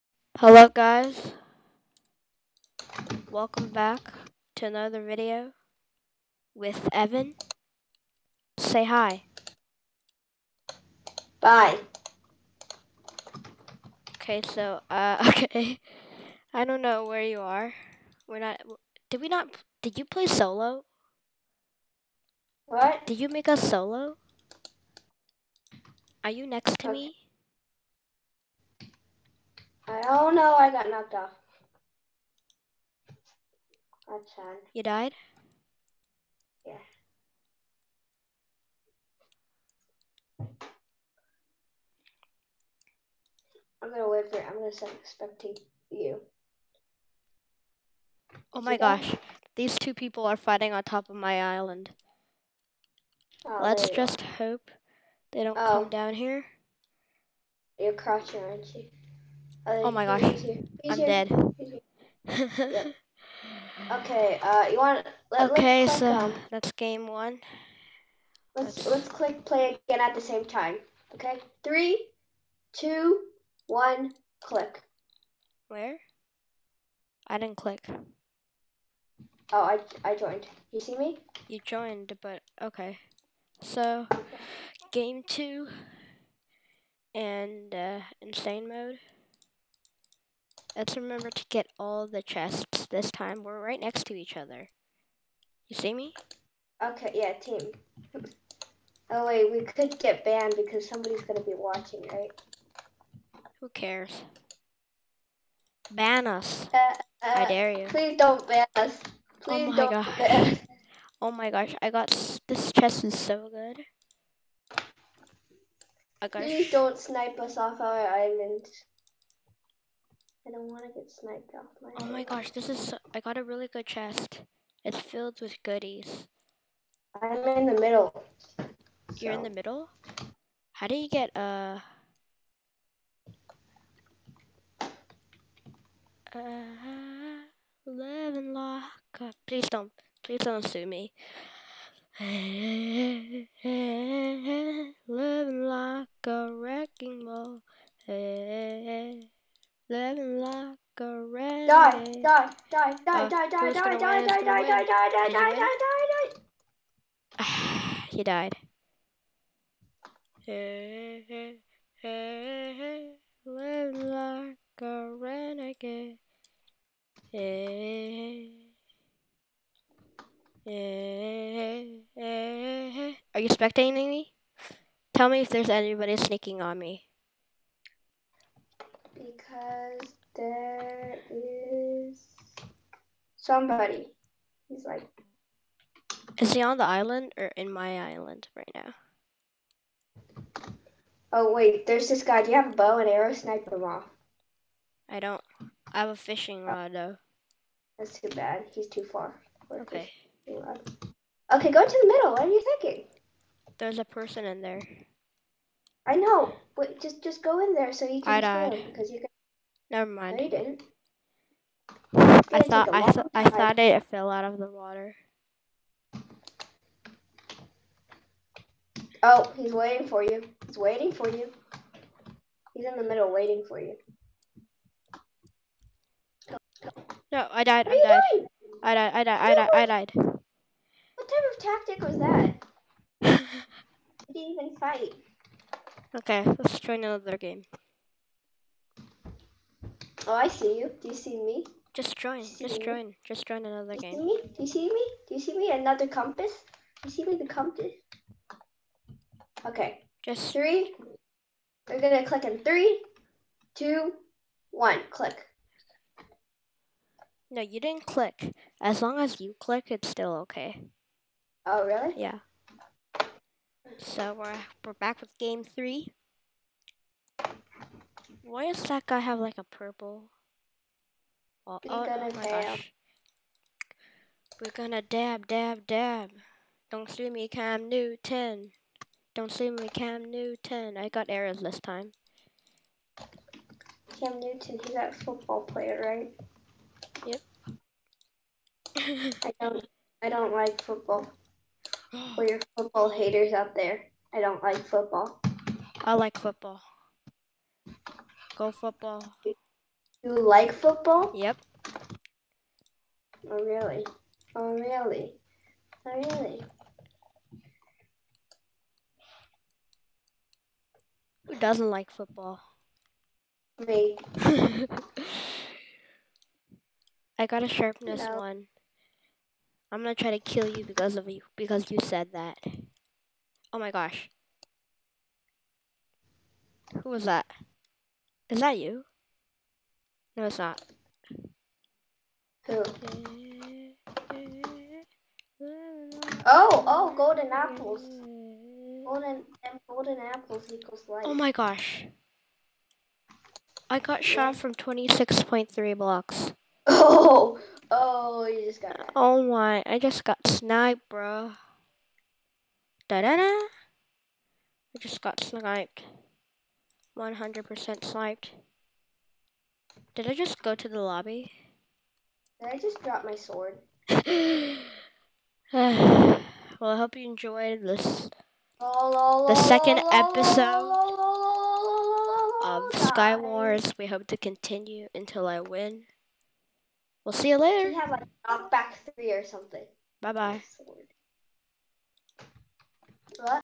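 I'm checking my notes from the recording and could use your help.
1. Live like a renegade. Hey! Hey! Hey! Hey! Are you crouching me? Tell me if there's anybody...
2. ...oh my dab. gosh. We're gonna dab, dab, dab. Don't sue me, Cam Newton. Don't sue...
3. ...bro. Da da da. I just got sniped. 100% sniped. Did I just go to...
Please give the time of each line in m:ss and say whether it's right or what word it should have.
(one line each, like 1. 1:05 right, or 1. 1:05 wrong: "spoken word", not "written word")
1. 2:43 wrong: "spectating", not "crouching"
2. 4:32 right
3. 5:51 right.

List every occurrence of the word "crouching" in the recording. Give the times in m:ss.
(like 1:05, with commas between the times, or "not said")
0:57.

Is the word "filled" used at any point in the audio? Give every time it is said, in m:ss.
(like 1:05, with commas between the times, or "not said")
2:04.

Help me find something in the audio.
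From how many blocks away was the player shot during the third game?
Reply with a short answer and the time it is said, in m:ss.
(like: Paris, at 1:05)
26.3, at 5:44.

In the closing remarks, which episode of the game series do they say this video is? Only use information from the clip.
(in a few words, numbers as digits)
Second.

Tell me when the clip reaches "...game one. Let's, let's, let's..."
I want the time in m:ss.
1:06.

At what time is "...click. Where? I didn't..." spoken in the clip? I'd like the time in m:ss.
1:14.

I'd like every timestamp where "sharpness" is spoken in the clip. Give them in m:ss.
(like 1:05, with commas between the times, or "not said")
5:17.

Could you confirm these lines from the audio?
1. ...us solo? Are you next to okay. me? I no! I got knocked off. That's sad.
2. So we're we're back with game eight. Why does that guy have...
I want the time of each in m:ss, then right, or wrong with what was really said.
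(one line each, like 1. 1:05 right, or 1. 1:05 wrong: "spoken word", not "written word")
1. 0:23 right
2. 4:23 wrong: "three", not "eight".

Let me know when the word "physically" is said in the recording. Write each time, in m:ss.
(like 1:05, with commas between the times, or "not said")
not said.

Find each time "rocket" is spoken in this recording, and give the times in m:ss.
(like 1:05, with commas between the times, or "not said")
not said.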